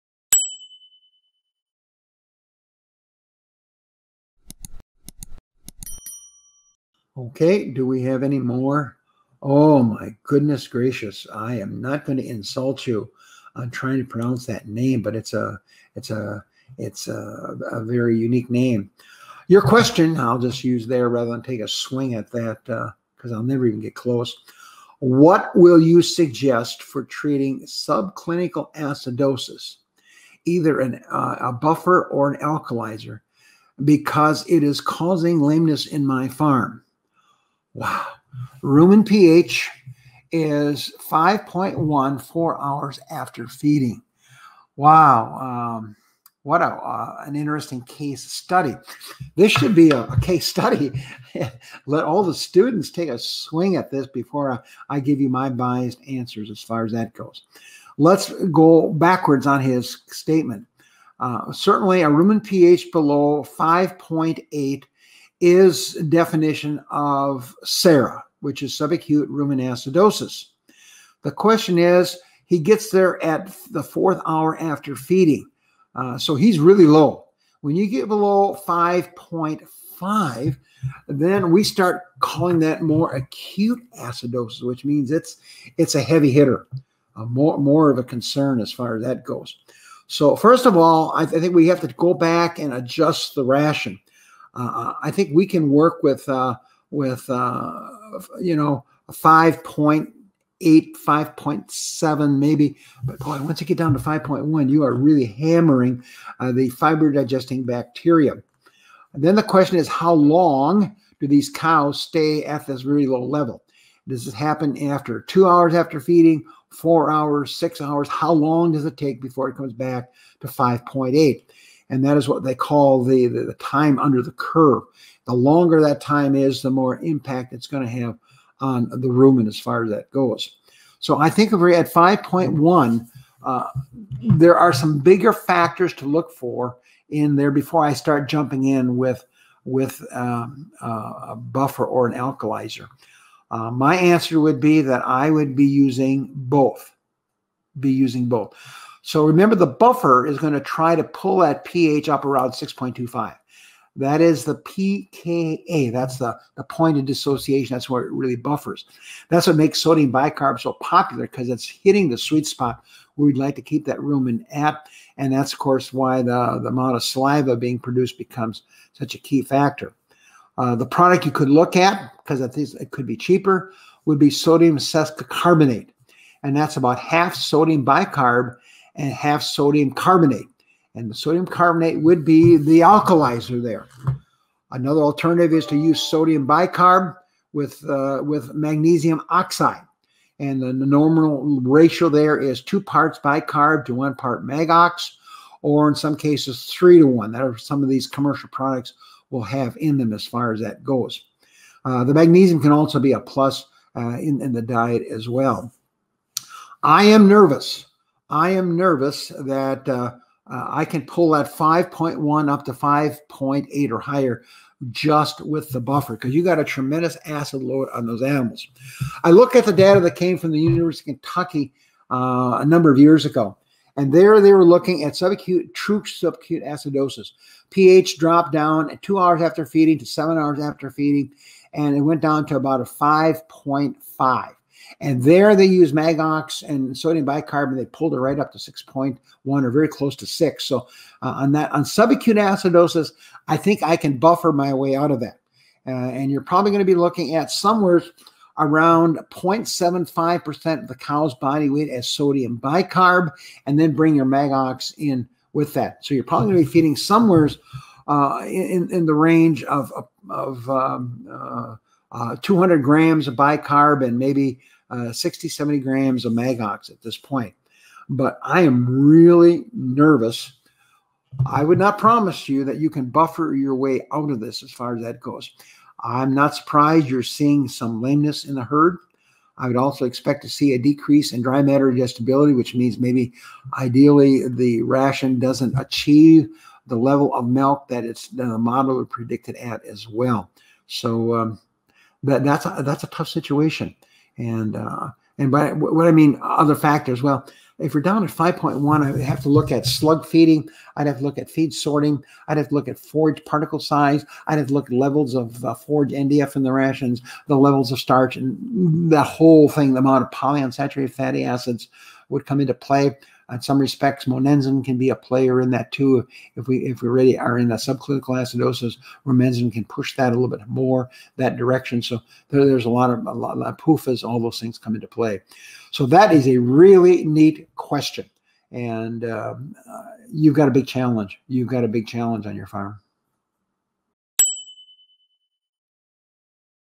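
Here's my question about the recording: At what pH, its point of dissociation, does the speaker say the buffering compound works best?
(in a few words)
6.25.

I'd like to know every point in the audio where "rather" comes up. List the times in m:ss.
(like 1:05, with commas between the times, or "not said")
0:21.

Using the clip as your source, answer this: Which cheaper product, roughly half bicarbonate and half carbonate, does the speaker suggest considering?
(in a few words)
Sodium sesquicarbonate.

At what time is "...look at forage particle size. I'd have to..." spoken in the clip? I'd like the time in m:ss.
5:02.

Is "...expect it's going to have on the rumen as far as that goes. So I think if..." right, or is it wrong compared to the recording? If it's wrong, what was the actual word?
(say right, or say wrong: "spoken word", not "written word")
wrong: "impact", not "expect".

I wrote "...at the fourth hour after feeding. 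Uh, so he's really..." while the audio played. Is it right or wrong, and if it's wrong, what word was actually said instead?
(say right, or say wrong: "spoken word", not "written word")
right.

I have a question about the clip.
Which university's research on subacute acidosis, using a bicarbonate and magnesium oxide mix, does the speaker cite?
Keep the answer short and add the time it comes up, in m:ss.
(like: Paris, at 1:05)
University of Kentucky, at 3:40.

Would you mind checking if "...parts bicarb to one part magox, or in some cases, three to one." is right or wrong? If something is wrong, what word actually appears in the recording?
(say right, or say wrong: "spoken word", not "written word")
right.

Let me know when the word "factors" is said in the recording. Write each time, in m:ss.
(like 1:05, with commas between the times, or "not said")
2:15, 2:49, 4:56.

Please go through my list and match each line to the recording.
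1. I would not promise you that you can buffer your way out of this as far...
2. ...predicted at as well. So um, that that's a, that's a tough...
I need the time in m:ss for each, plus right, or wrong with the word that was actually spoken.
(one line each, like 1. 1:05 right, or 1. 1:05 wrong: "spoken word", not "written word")
1. 4:31 right
2. 4:49 right.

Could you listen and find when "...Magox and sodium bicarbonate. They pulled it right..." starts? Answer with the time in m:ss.
3:55.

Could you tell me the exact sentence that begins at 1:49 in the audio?
And then the question is, how long do these cows stay at this really low level?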